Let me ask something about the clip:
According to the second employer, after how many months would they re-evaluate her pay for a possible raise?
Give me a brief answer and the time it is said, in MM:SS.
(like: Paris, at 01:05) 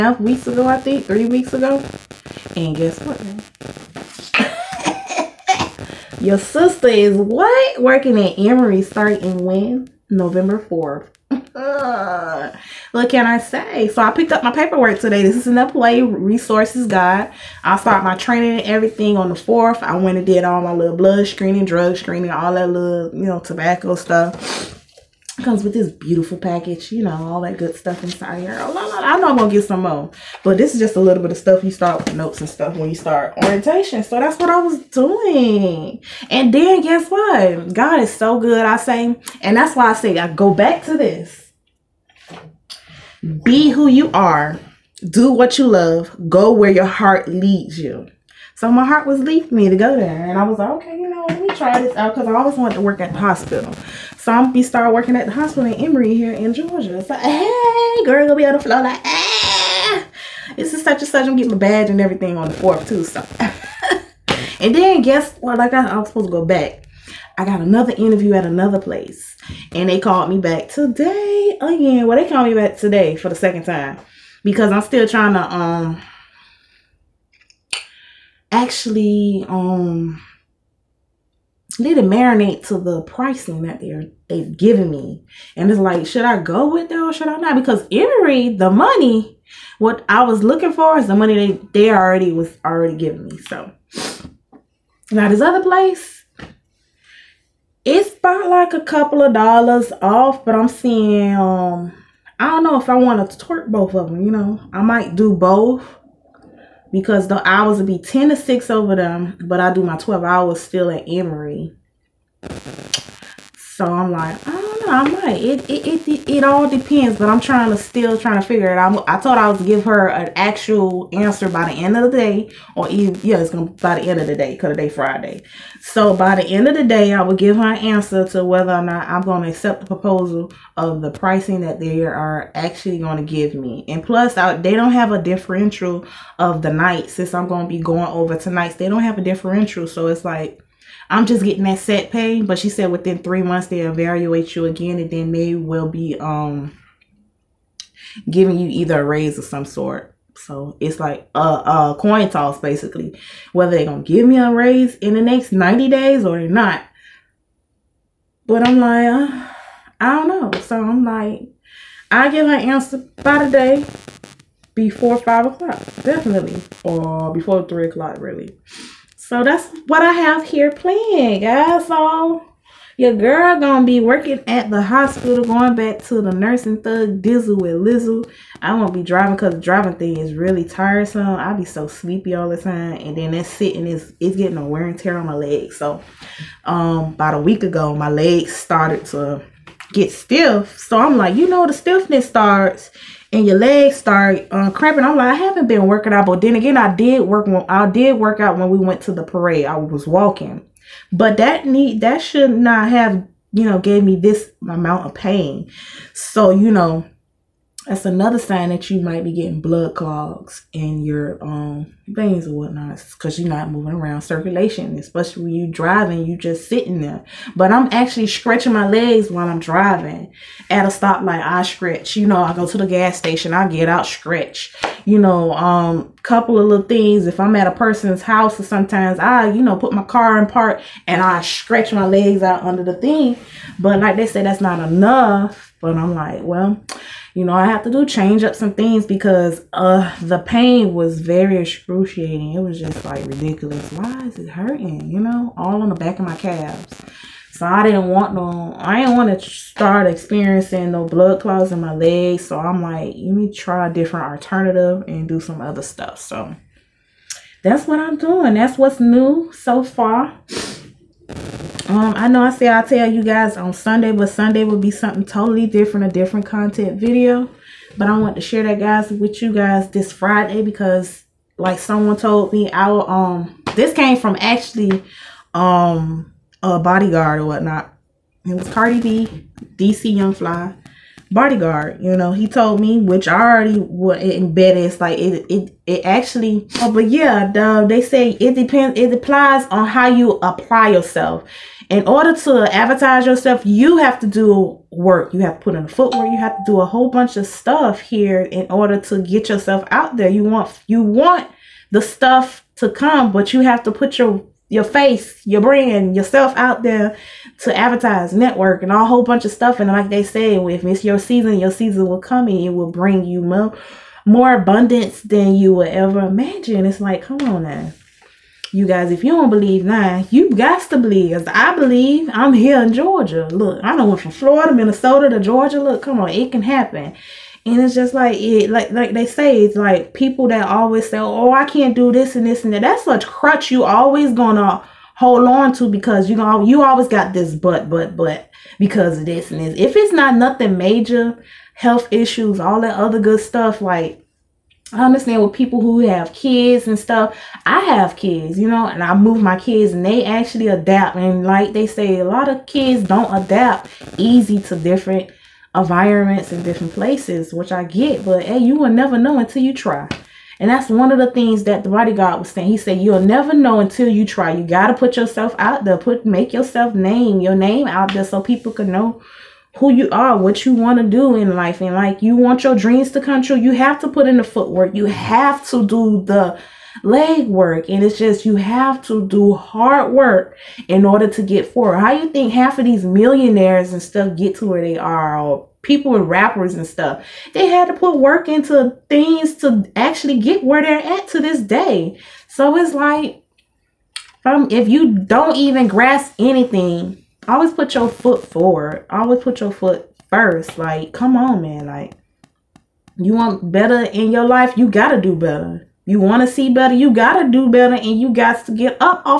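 three months, at 02:23.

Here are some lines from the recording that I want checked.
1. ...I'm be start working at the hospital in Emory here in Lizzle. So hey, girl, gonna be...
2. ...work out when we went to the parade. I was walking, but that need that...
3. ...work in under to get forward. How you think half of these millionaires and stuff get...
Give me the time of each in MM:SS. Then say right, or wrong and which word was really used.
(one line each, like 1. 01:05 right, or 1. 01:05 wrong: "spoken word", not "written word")
1. 00:54 wrong: "Georgia", not "Lizzle"
2. 03:18 right
3. 06:20 wrong: "order", not "under".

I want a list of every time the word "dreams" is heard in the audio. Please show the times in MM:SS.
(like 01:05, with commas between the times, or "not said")
06:12.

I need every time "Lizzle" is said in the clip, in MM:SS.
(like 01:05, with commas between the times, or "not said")
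02:57.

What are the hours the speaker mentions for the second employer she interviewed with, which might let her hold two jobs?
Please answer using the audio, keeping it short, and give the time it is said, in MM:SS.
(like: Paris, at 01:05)
10 to 6, at 01:47.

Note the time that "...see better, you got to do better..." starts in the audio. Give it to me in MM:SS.
06:46.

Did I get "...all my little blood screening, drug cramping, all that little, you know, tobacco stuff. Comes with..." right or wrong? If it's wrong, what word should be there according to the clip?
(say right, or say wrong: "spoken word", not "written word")
wrong: "screening", not "cramping".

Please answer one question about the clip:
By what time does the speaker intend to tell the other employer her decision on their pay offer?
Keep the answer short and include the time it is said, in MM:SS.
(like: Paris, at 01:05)
three o'clock, at 02:47.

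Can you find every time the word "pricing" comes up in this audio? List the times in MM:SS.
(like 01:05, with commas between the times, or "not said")
01:23, 02:11.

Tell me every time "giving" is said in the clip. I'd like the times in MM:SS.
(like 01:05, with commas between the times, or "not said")
01:32, 02:28.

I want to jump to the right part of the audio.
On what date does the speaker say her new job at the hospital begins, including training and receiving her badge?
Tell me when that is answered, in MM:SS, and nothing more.
00:10.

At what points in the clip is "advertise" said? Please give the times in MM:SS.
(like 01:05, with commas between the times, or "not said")
04:52, 05:07.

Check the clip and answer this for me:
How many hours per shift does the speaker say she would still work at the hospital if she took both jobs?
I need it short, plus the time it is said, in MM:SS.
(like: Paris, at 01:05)
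12 hours, at 01:49.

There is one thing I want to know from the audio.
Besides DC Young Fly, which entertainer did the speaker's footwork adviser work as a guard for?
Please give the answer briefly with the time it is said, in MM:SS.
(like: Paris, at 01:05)
Cardi B, at 04:38.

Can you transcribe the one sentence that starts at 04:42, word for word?
You know, he told me, which I already was embedded.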